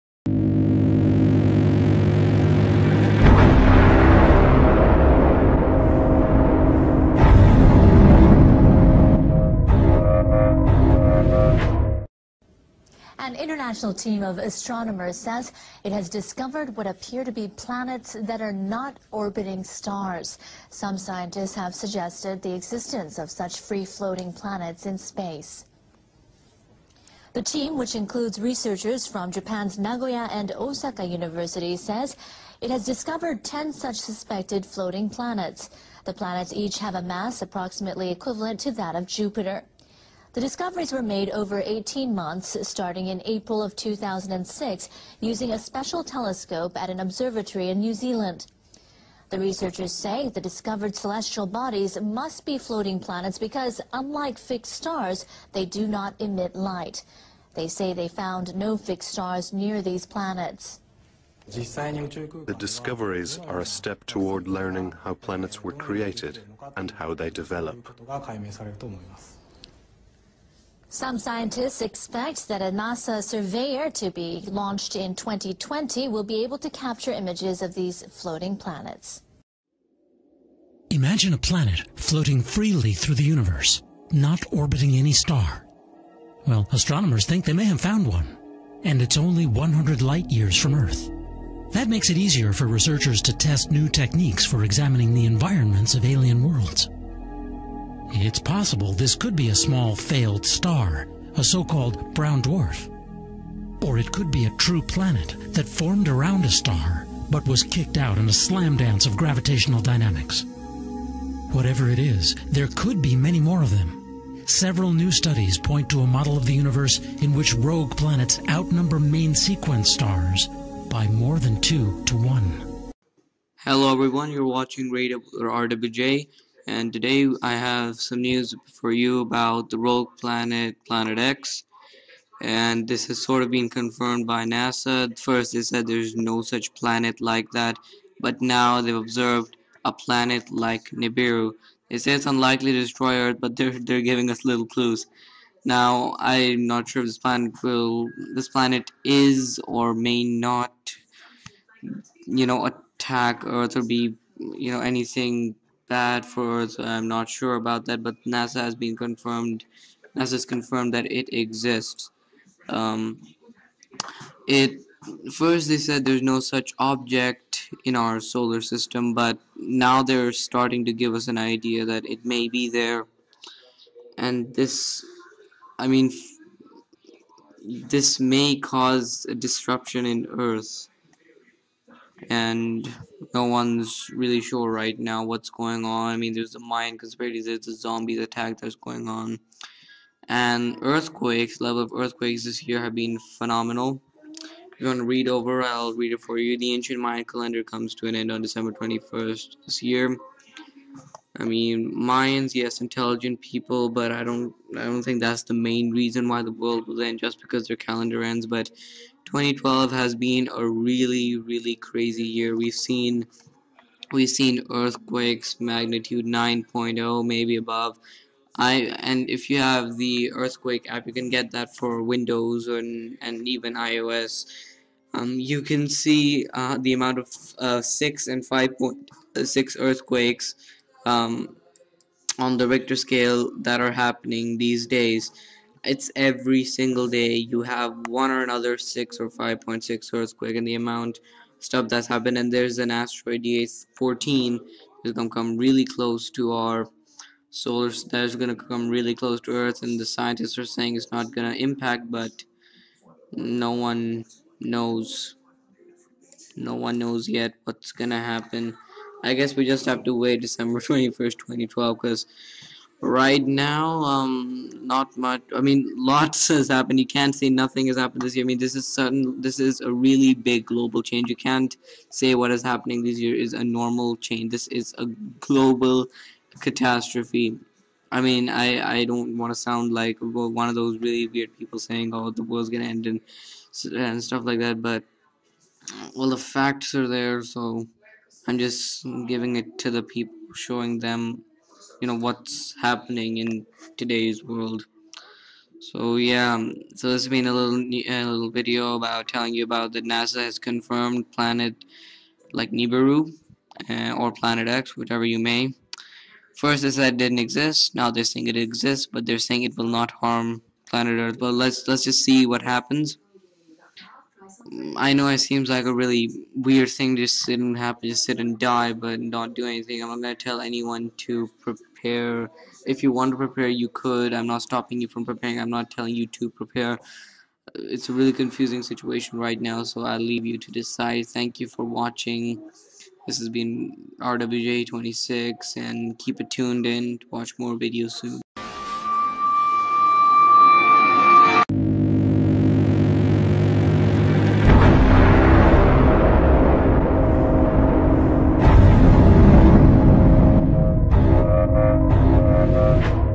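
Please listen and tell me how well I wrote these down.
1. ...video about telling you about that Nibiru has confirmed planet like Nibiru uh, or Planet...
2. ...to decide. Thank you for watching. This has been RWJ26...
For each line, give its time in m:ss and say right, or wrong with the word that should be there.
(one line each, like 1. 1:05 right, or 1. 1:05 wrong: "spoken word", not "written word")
1. 4:58 wrong: "NASA", not "Nibiru"
2. 5:30 right.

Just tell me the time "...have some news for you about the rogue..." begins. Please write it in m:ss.
2:07.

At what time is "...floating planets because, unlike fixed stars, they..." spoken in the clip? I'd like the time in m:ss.
0:52.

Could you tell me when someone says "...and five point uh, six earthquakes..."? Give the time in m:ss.
3:48.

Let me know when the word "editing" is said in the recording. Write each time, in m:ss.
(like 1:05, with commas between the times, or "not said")
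not said.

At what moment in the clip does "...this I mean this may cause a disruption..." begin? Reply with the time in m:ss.
2:54.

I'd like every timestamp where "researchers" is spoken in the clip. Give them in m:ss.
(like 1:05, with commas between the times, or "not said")
0:28, 0:49, 1:32.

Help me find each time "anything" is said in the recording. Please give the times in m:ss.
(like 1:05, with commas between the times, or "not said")
2:34, 5:19.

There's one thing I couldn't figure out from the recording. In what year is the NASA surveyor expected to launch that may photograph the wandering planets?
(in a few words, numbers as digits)
2020.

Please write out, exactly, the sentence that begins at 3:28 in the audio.
But 2012 has been a really, really crazy year.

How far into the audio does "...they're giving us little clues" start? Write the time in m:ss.
2:23.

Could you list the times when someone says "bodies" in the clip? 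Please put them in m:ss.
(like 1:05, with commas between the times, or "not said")
0:51.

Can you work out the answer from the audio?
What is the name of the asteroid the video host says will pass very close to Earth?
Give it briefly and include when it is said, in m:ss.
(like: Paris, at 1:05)
DA14, at 4:03.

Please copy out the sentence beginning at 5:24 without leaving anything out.
I'm not stopping you from preparing.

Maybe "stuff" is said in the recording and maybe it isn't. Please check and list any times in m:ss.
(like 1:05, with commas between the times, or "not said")
4:01, 4:44.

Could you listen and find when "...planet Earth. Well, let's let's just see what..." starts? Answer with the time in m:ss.
5:10.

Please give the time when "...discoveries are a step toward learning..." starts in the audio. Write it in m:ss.
1:02.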